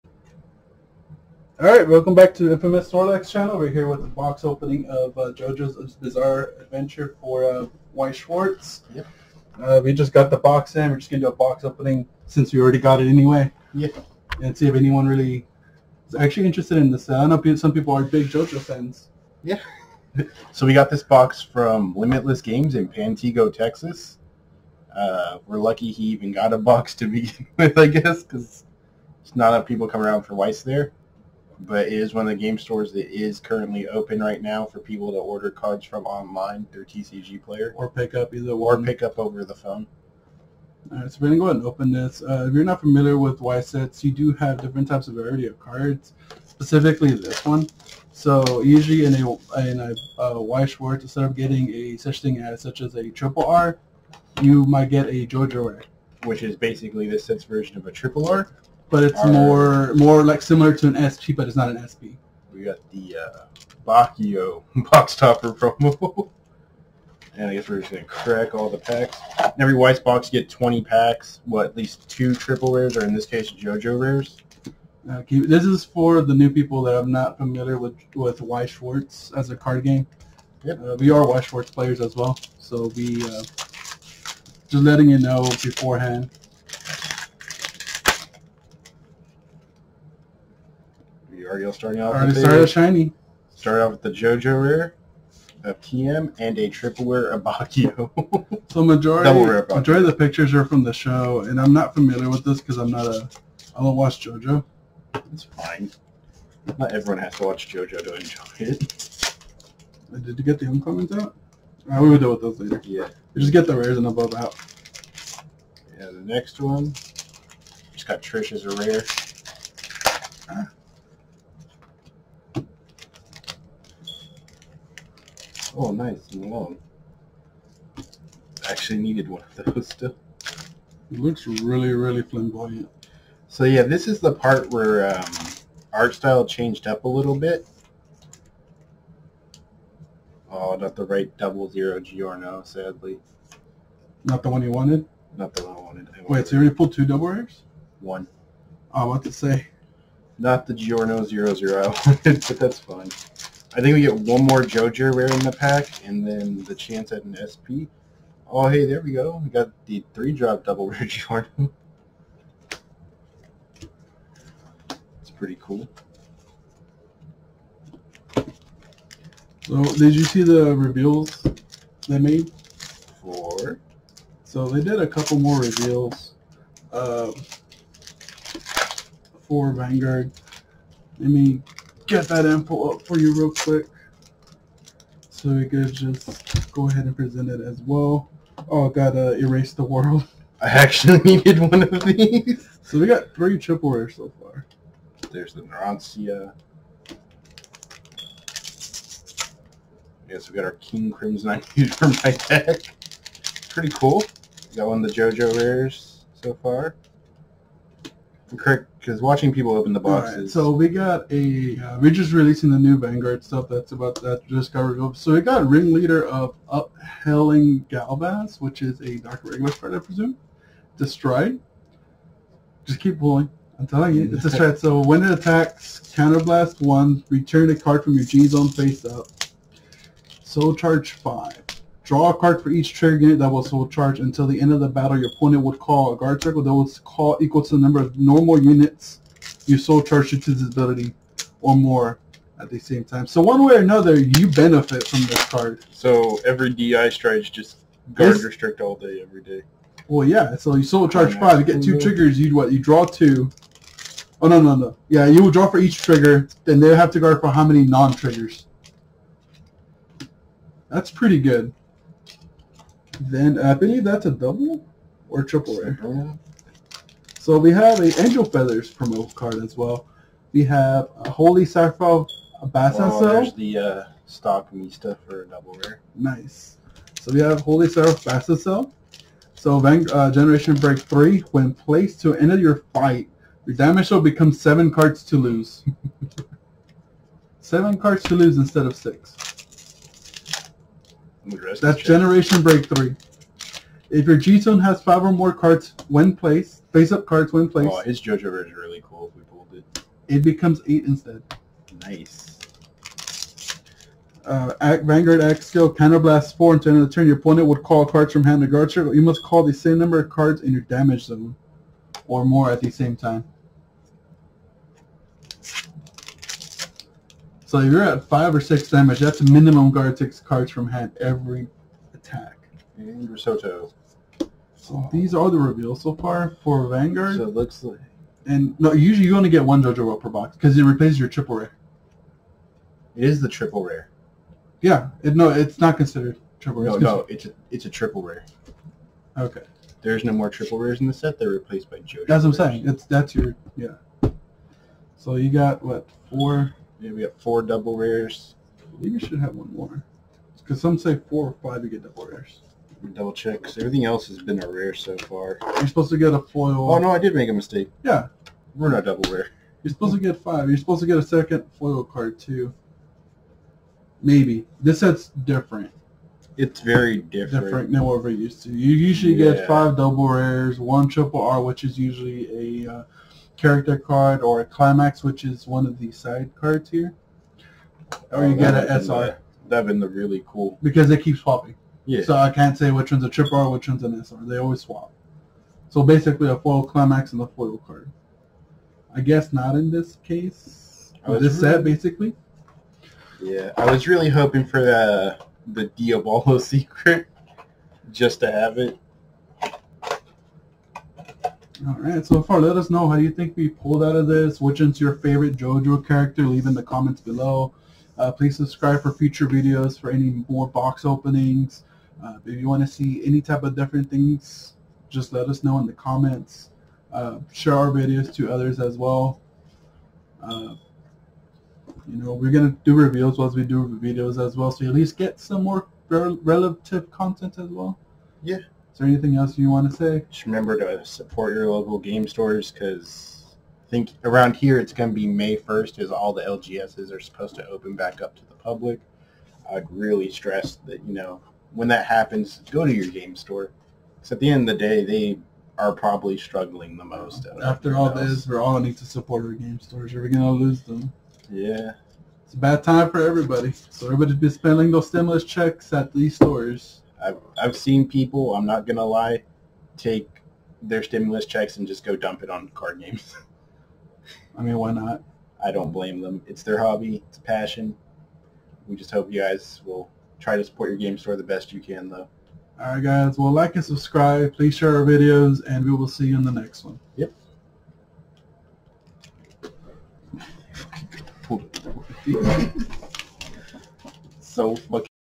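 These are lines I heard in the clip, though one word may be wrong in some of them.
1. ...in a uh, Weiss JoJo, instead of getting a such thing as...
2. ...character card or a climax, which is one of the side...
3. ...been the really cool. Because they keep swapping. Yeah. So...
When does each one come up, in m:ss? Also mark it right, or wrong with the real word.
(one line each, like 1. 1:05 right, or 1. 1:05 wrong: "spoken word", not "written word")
1. 0:49 wrong: "Schwartz", not "JoJo"
2. 6:13 right
3. 6:19 right.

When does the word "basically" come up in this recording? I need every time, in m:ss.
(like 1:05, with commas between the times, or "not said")
0:56, 6:26, 6:31.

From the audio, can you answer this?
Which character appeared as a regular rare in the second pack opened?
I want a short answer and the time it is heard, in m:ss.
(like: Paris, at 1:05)
Trish, at 1:58.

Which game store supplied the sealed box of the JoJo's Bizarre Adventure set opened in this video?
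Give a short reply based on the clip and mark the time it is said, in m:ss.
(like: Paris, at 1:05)
Limitless Games, at 0:21.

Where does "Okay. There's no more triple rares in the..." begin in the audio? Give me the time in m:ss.
5:39.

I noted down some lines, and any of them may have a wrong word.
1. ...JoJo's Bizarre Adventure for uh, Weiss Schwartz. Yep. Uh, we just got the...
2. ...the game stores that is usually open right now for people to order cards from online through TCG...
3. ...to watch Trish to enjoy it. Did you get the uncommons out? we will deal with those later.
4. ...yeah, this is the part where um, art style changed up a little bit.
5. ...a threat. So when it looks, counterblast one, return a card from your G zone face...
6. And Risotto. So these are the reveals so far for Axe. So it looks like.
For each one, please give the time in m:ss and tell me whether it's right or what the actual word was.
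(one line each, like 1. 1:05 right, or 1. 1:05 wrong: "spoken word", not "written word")
1. 0:05 right
2. 0:32 wrong: "currently", not "usually"
3. 1:47 wrong: "JoJo", not "Trish"
4. 2:13 right
5. 3:44 wrong: "attacks", not "looks"
6. 5:22 wrong: "Vanguard", not "Axe".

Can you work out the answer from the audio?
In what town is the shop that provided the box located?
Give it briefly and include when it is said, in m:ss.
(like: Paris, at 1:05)
Pantego, Texas, at 0:22.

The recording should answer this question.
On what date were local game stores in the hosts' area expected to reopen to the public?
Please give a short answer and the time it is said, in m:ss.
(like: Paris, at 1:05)
May 1st, at 7:15.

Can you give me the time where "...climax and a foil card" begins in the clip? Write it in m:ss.
6:26.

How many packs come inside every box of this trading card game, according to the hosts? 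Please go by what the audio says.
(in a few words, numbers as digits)
20.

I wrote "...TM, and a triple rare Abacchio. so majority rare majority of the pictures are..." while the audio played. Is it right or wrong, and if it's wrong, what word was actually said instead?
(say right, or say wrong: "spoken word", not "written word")
right.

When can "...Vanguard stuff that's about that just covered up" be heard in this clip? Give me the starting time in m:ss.
3:32.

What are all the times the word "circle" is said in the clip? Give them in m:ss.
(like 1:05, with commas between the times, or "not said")
3:56, 5:08.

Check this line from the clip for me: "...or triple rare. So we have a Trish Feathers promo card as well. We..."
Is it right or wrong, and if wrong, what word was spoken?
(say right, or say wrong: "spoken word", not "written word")
wrong: "Angel", not "Trish".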